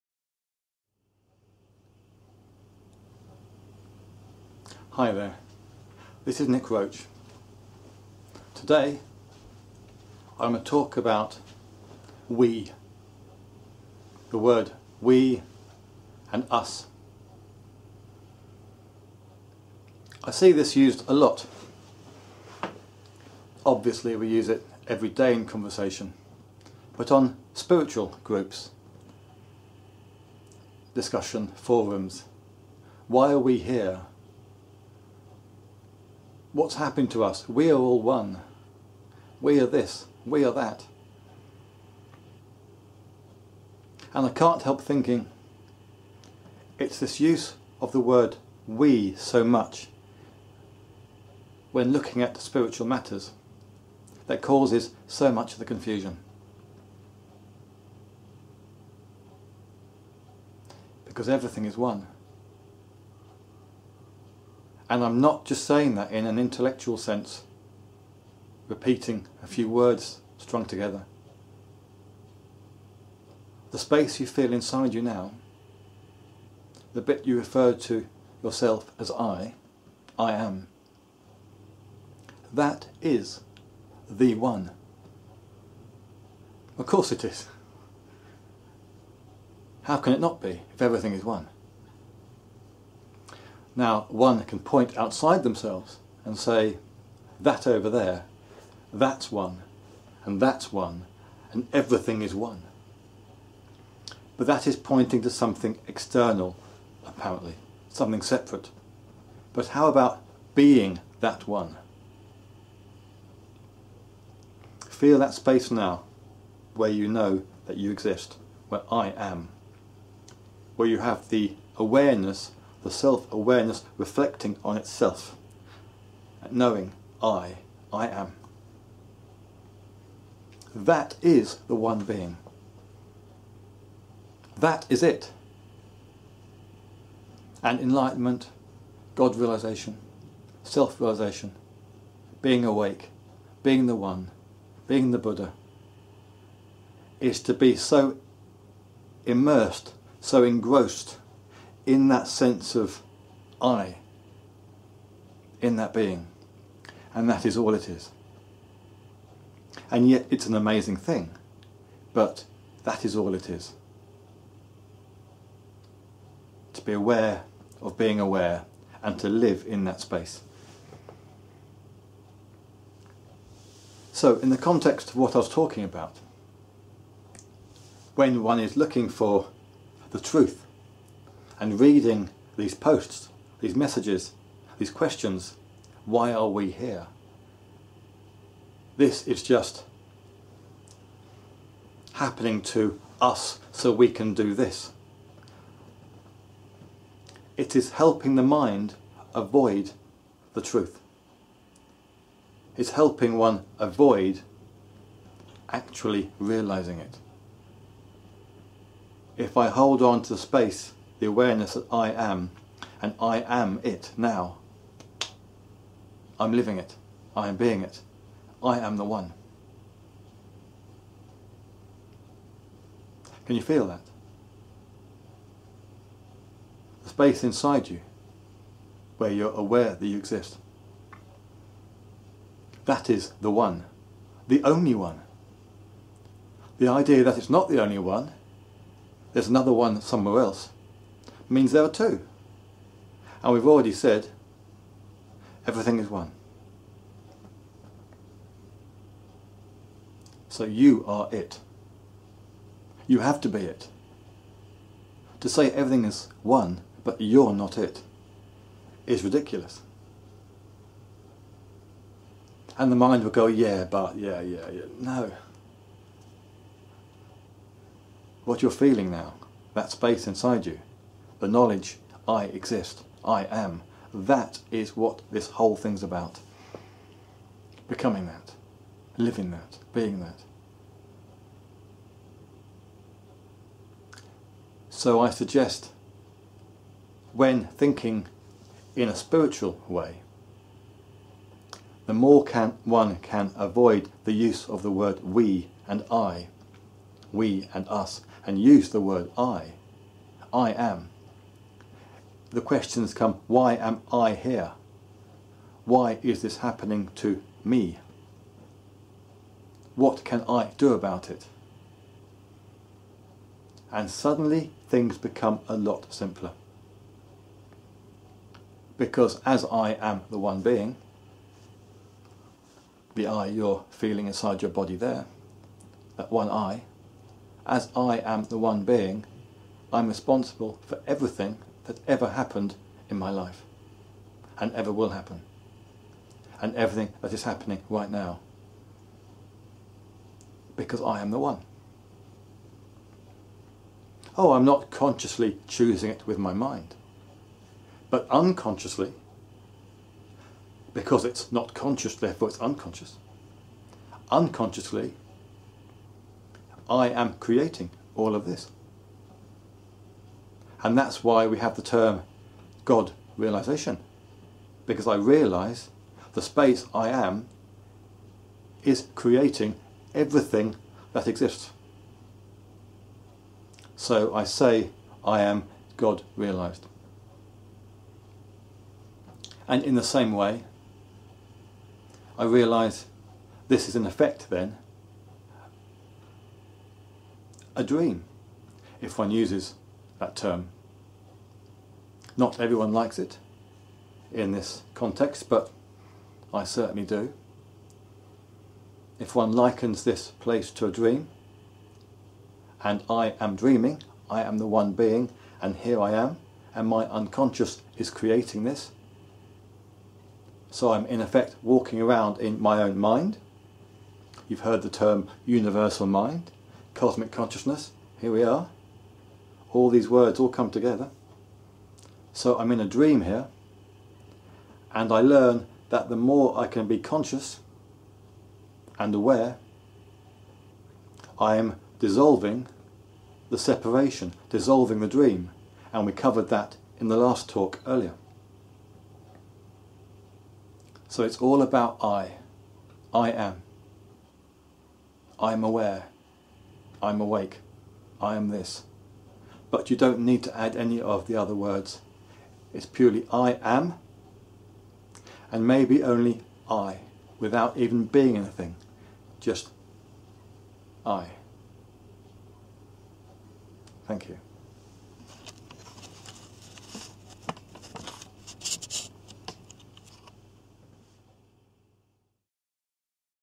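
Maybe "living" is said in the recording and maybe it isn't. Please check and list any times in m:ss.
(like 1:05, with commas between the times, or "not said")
3:36, 4:39.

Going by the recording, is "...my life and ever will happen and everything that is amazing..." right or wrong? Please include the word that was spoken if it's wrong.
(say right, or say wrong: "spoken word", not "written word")
wrong: "happening", not "amazing".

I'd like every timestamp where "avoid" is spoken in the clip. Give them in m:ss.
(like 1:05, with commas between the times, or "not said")
3:19, 3:23, 4:53.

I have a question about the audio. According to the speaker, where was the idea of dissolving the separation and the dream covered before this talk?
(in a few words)
the last talk.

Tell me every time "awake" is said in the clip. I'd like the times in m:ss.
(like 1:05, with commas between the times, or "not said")
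2:22, 7:27.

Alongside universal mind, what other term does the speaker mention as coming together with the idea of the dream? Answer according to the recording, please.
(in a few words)
cosmic consciousness.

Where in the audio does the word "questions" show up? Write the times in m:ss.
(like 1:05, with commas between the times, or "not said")
3:04, 5:02.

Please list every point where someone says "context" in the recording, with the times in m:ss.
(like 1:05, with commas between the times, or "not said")
2:54, 6:34.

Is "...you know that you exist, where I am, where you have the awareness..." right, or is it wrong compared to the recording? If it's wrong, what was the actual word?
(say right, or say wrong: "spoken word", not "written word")
right.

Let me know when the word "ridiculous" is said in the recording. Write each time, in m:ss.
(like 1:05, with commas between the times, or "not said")
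4:19.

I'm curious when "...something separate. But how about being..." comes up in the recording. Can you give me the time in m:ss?
1:47.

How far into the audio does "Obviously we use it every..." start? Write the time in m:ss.
0:23.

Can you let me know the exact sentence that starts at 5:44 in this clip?
Oh, I'm not consciously choosing it with my mind, but unconsciously, because it's not conscious, therefore it's unconscious.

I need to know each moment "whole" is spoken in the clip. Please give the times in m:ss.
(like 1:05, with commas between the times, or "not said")
4:35.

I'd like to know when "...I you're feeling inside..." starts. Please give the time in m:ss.
5:23.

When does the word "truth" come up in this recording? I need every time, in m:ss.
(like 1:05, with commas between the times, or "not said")
3:00, 3:20.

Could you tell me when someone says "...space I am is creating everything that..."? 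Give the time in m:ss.
6:06.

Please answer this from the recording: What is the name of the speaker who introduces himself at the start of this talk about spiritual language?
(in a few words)
Nick Roach.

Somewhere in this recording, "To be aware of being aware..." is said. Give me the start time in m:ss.
2:46.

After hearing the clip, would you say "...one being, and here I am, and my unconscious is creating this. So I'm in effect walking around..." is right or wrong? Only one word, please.
right.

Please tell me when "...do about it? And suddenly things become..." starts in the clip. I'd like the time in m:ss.
5:10.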